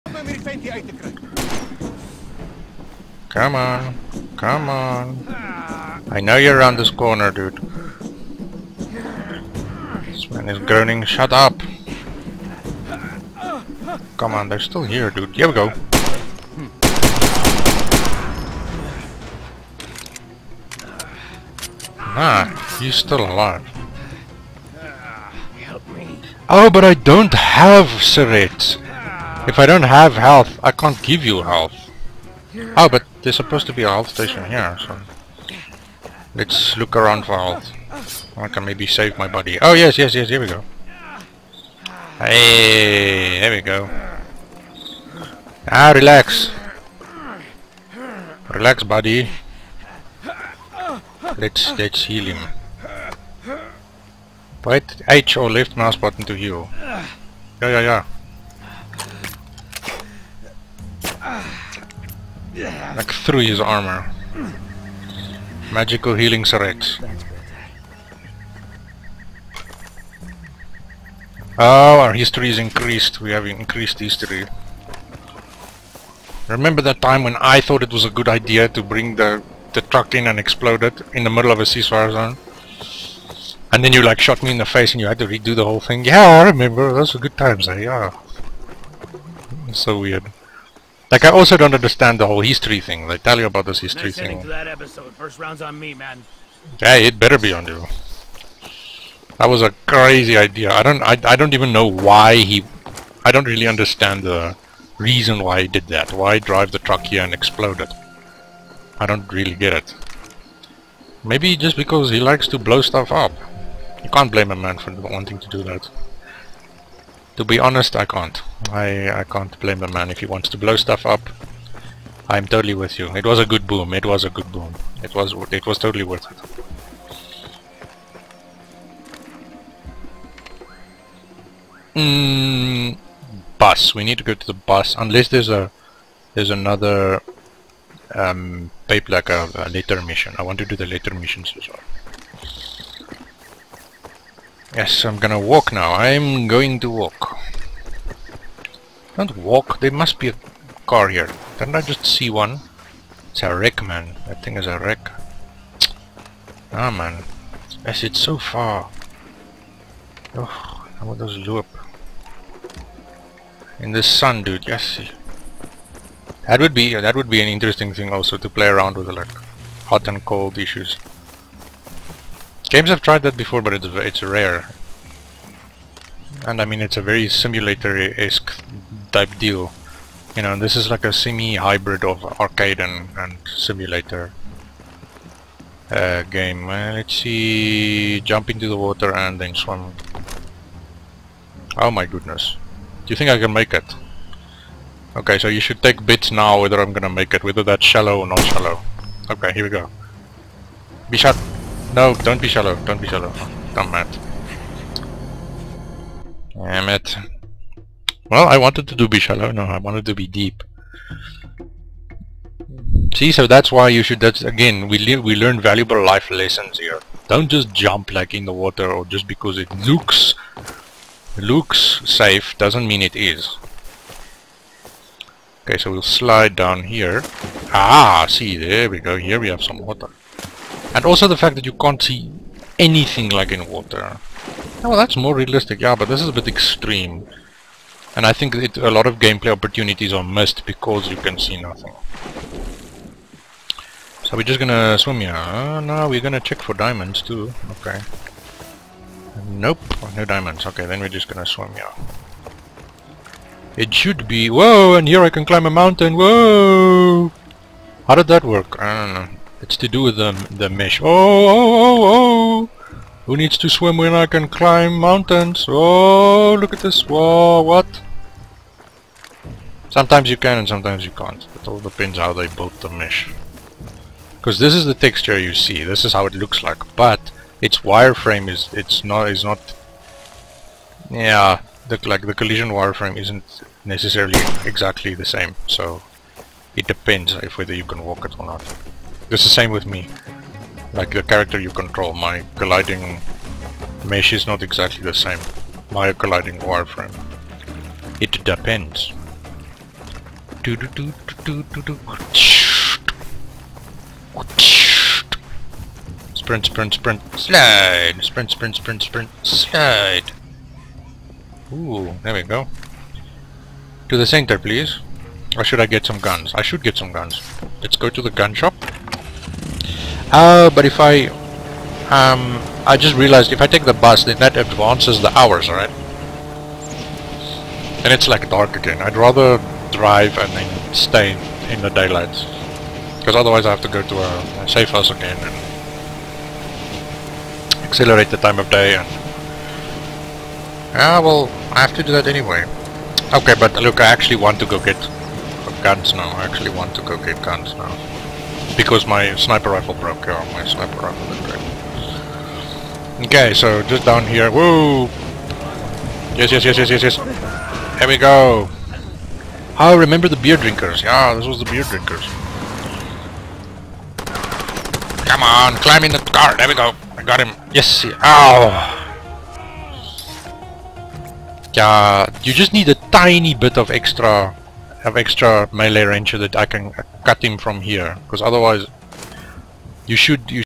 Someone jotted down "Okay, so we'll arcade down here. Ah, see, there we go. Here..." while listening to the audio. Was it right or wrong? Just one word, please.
wrong.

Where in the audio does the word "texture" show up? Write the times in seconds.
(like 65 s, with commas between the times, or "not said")
274 s.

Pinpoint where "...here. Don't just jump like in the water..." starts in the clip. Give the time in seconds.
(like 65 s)
216 s.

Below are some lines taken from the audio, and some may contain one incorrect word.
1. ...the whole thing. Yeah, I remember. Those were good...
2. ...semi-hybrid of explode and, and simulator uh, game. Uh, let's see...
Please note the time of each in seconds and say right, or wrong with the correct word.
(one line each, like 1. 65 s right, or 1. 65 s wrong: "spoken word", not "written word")
1. 85 s right
2. 181 s wrong: "arcade", not "explode".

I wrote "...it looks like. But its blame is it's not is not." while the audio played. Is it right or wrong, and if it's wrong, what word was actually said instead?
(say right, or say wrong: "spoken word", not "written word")
wrong: "wireframe", not "blame".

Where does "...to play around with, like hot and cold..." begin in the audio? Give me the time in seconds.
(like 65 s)
168 s.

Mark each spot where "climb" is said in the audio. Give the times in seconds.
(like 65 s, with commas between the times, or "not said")
255 s, 264 s, 365 s.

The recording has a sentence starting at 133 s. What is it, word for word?
We need to go to the bus unless there's a there's another um, pipe like a, a later mission.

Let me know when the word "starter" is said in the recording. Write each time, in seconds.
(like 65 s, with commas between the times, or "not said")
not said.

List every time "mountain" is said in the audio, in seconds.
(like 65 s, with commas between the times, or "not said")
255 s, 264 s.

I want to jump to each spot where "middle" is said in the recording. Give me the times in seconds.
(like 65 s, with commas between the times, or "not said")
81 s.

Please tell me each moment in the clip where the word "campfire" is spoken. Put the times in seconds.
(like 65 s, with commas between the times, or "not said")
not said.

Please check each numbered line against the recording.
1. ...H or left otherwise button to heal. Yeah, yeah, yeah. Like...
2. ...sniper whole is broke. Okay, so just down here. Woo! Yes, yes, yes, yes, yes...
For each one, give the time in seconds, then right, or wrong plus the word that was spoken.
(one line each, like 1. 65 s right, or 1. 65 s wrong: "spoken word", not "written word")
1. 55 s wrong: "mouse", not "otherwise"
2. 350 s wrong: "rifle", not "whole".